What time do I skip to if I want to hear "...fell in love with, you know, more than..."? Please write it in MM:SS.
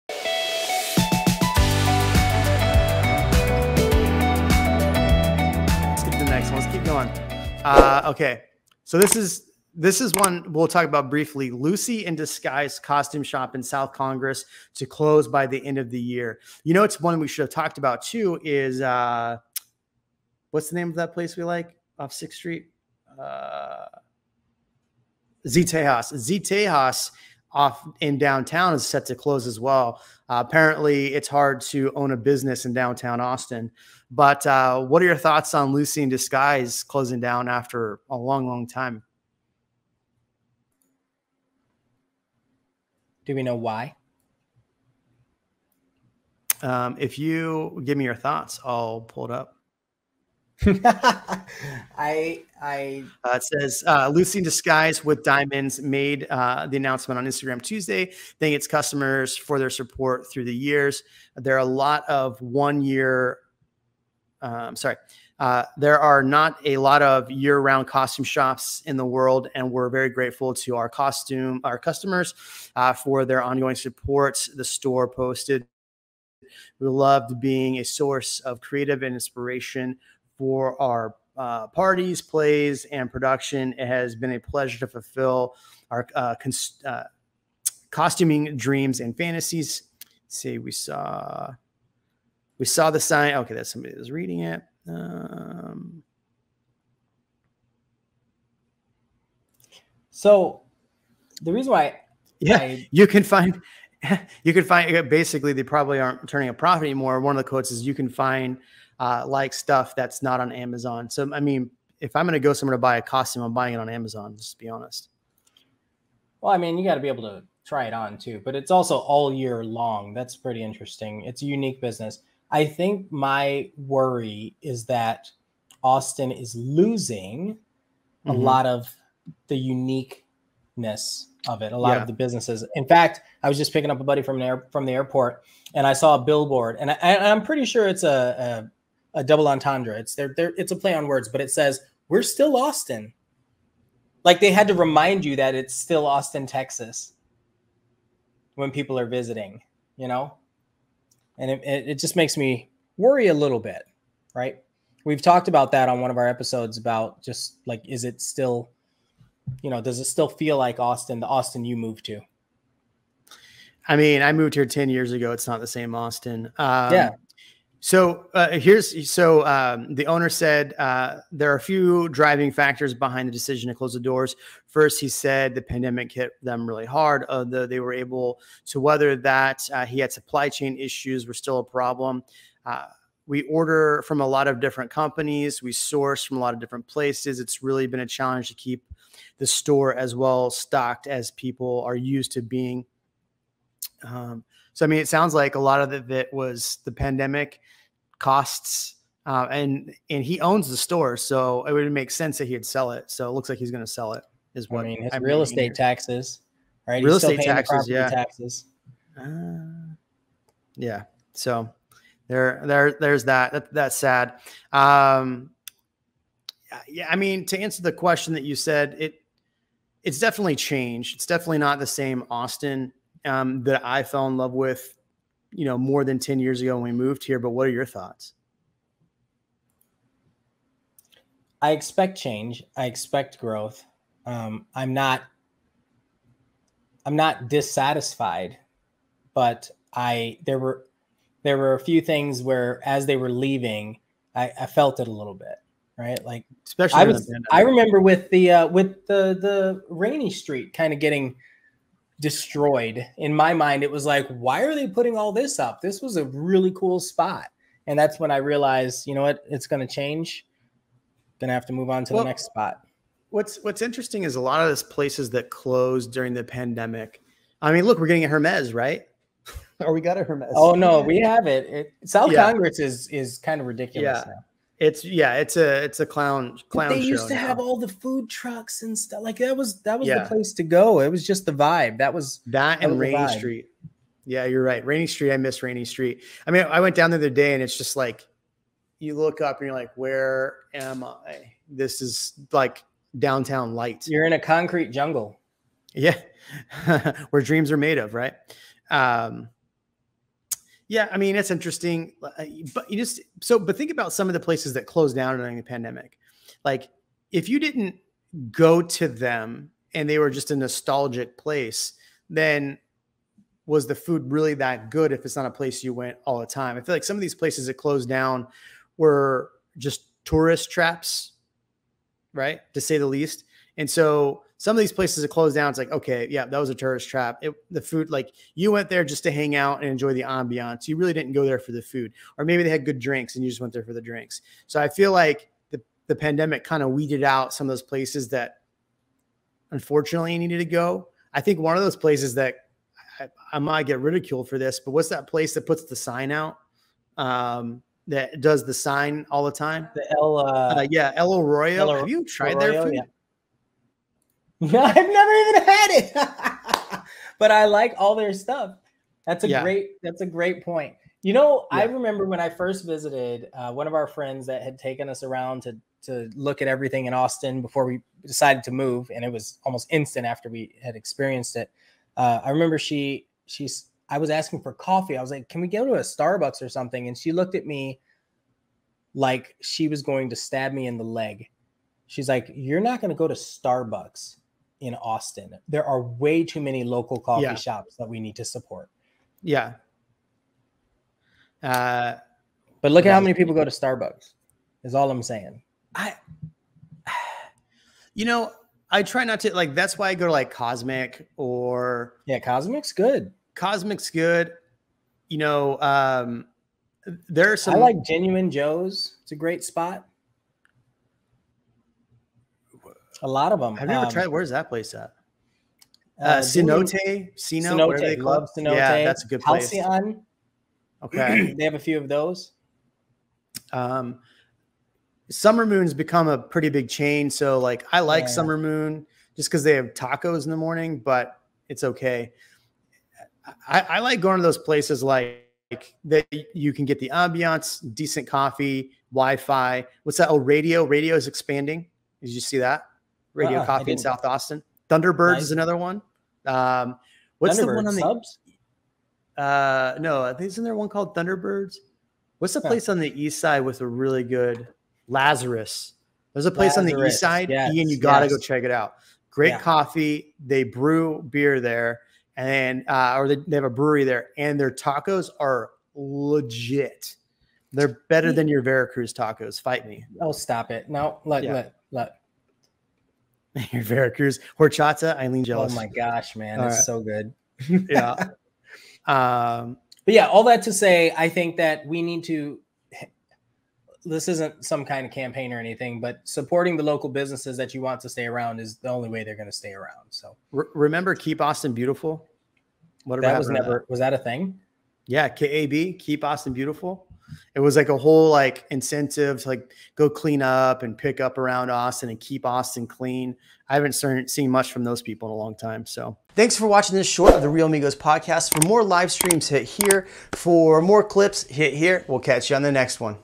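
03:44.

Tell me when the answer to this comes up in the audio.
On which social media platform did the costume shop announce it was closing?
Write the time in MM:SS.
00:57.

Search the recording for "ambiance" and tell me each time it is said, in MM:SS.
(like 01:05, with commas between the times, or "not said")
05:30, 07:17.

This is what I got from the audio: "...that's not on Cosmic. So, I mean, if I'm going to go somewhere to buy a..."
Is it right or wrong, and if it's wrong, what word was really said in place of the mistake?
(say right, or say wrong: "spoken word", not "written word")
wrong: "Amazon", not "Cosmic".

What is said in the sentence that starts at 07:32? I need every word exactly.
What's the place on the east side with a really good Lazarus?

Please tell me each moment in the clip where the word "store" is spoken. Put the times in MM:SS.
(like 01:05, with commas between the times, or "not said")
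01:14, 03:09, 03:20.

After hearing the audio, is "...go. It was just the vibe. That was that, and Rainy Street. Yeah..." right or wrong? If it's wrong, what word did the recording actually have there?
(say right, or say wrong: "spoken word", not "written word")
right.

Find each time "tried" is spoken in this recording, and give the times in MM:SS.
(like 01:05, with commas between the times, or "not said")
05:52, 06:54.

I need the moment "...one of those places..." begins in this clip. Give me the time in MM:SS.
05:41.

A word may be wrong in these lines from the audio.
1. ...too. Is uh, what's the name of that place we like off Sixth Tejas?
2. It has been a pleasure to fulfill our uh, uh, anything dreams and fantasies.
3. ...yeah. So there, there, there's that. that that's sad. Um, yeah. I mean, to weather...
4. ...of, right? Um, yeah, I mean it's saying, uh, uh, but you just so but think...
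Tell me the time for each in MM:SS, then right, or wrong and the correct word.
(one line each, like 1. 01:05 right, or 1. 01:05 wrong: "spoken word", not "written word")
1. 00:18 wrong: "Street", not "Tejas"
2. 01:23 wrong: "costuming", not "anything"
3. 03:30 wrong: "answer", not "weather"
4. 04:57 wrong: "interesting", not "saying".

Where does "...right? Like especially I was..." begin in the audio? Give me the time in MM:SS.
04:05.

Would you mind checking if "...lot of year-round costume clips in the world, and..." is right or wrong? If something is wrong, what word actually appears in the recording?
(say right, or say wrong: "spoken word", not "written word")
wrong: "shops", not "clips".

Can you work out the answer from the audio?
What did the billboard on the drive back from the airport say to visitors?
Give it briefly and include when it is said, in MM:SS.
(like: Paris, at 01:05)
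We're still Austin, at 02:22.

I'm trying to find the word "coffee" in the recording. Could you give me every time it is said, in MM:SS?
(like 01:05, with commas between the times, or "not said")
06:14, 06:27, 07:18, 07:23, 07:39.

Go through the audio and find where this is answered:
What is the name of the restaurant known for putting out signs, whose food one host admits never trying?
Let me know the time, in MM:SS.
05:51.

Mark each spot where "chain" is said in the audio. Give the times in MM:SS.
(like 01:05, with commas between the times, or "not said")
03:00, 07:06.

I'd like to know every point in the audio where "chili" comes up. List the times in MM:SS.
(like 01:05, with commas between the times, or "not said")
not said.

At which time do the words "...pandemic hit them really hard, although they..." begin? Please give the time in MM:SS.
02:55.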